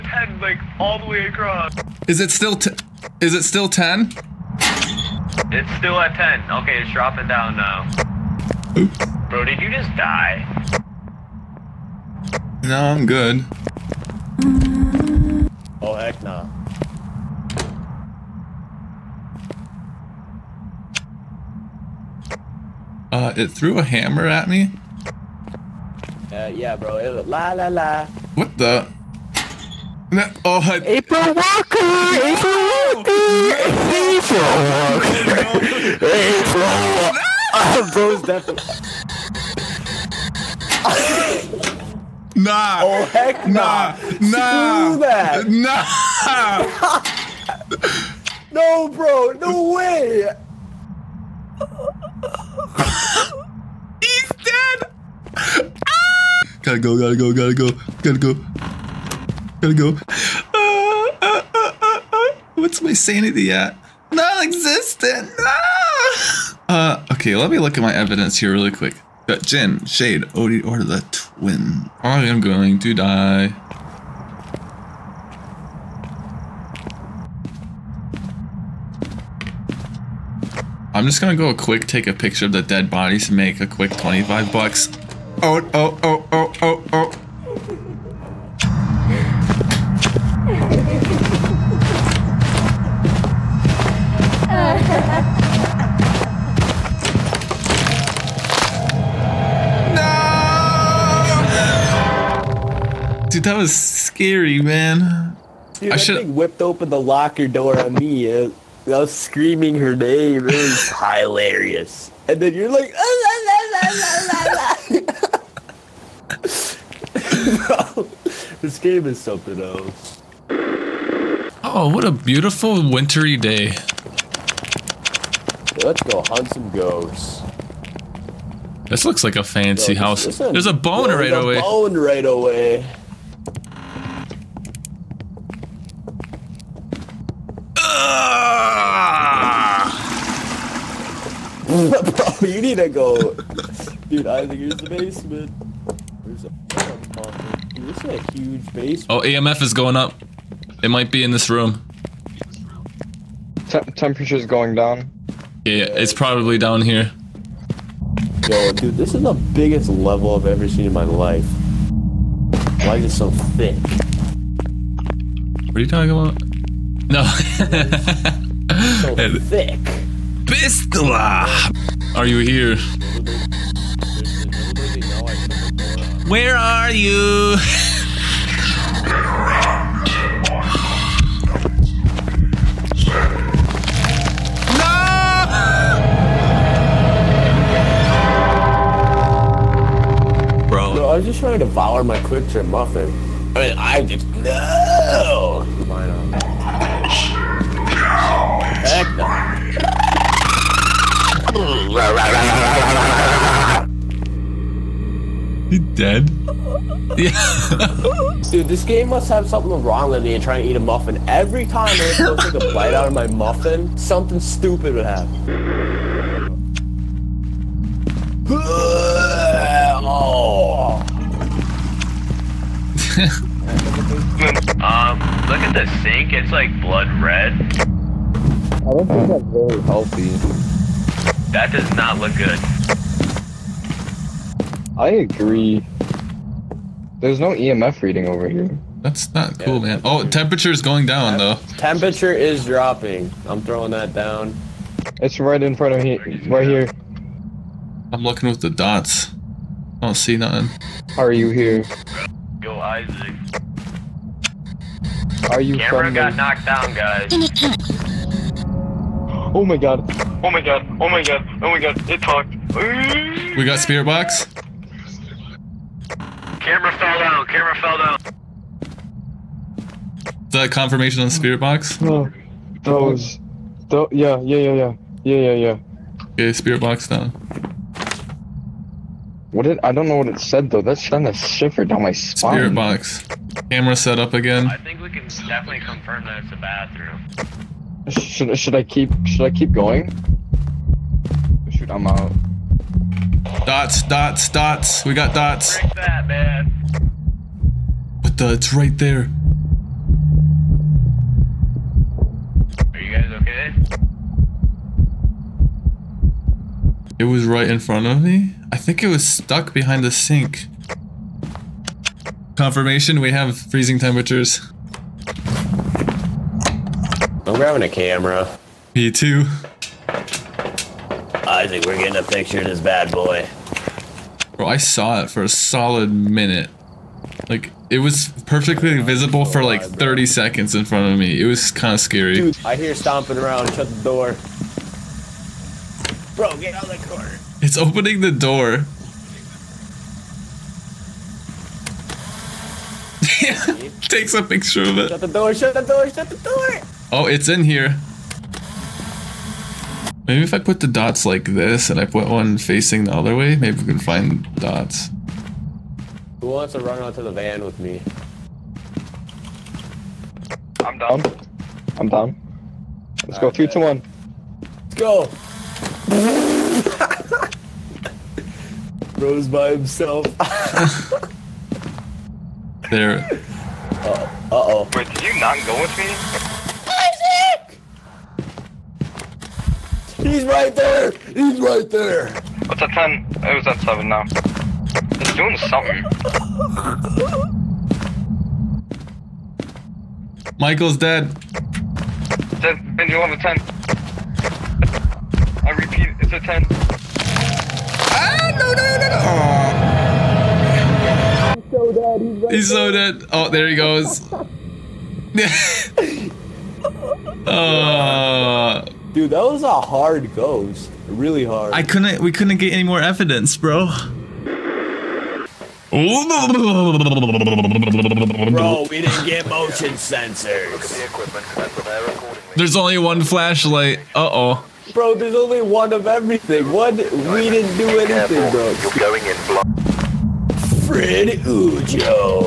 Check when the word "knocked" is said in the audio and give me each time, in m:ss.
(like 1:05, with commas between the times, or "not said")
4:16.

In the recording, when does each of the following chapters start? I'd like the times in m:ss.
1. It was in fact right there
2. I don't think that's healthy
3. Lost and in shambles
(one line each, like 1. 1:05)
1. 1:59
2. 3:34
3. 6:53.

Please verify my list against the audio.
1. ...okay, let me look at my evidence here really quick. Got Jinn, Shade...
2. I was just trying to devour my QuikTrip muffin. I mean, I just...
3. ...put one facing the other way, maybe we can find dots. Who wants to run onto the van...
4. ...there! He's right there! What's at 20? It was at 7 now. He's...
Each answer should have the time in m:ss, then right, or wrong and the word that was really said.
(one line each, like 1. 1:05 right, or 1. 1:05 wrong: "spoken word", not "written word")
1. 1:07 right
2. 3:11 right
3. 5:52 right
4. 6:20 wrong: "10", not "20".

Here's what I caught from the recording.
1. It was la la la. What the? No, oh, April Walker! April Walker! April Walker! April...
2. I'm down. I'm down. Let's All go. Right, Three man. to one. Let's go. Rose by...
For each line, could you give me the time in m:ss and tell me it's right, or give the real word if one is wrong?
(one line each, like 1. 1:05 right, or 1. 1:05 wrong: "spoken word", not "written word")
1. 0:26 right
2. 6:00 right.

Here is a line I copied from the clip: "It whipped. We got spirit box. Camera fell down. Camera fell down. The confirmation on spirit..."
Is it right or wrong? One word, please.
wrong.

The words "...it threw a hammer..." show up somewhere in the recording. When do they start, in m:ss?
0:23.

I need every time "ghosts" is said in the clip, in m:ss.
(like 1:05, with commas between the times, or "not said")
2:06, 6:50.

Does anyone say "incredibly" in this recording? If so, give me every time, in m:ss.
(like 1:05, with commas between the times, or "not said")
not said.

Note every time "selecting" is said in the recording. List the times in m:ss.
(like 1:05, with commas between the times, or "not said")
not said.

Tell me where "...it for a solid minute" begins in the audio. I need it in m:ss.
5:25.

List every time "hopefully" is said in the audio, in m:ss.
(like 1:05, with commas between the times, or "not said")
not said.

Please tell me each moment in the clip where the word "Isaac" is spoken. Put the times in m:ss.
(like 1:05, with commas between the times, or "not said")
4:12, 5:20.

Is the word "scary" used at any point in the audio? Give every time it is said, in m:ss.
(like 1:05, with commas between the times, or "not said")
1:43, 5:31.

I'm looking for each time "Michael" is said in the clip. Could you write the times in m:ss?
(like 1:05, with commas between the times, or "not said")
6:30.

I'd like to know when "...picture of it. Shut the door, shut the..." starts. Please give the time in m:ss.
5:44.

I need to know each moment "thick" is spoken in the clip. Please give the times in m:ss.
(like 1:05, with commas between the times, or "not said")
2:43, 2:49.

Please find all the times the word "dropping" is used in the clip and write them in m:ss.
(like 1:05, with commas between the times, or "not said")
0:06, 4:02.